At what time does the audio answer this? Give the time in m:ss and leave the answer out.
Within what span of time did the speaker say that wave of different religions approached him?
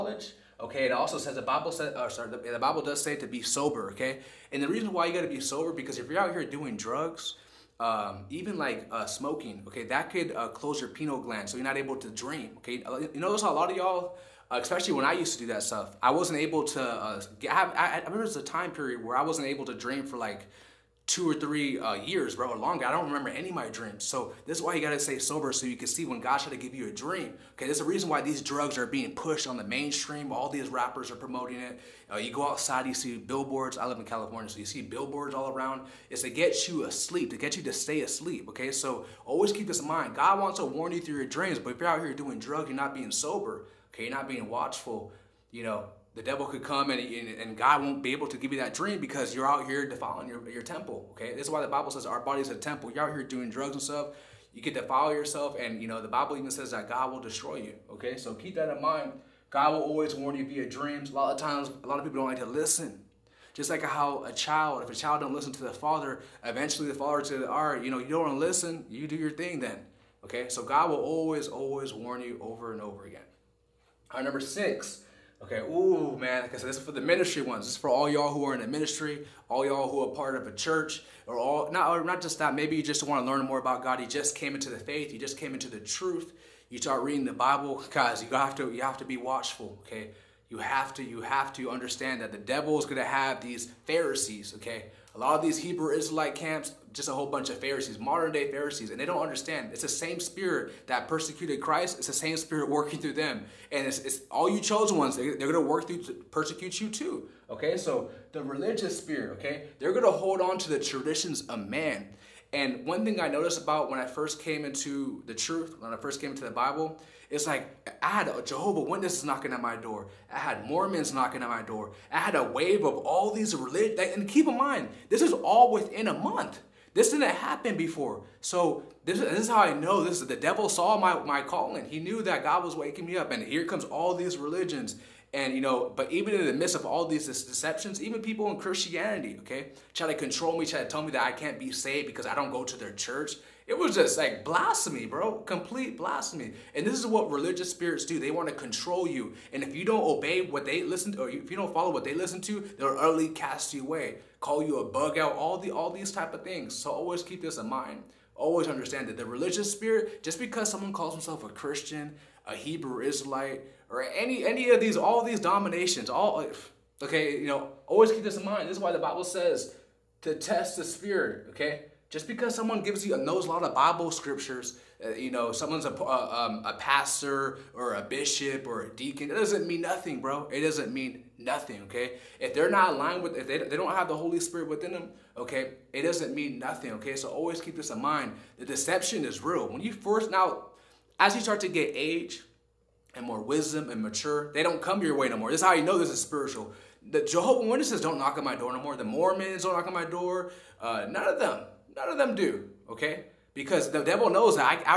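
2:06.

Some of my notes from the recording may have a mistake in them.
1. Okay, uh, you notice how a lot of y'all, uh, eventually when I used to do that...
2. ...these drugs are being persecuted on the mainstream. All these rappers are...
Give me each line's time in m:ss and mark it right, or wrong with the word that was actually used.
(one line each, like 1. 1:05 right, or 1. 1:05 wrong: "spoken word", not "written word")
1. 0:12 wrong: "especially", not "eventually"
2. 0:28 wrong: "pushed", not "persecuted".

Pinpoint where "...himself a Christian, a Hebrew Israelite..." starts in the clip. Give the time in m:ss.
2:41.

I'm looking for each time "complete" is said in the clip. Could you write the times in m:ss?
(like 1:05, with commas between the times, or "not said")
2:25.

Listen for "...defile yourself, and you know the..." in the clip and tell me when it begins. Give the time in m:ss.
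0:54.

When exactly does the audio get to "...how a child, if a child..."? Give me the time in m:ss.
1:03.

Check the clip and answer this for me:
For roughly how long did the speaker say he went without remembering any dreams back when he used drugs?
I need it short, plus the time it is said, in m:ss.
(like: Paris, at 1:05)
2 or 3 years, at 0:21.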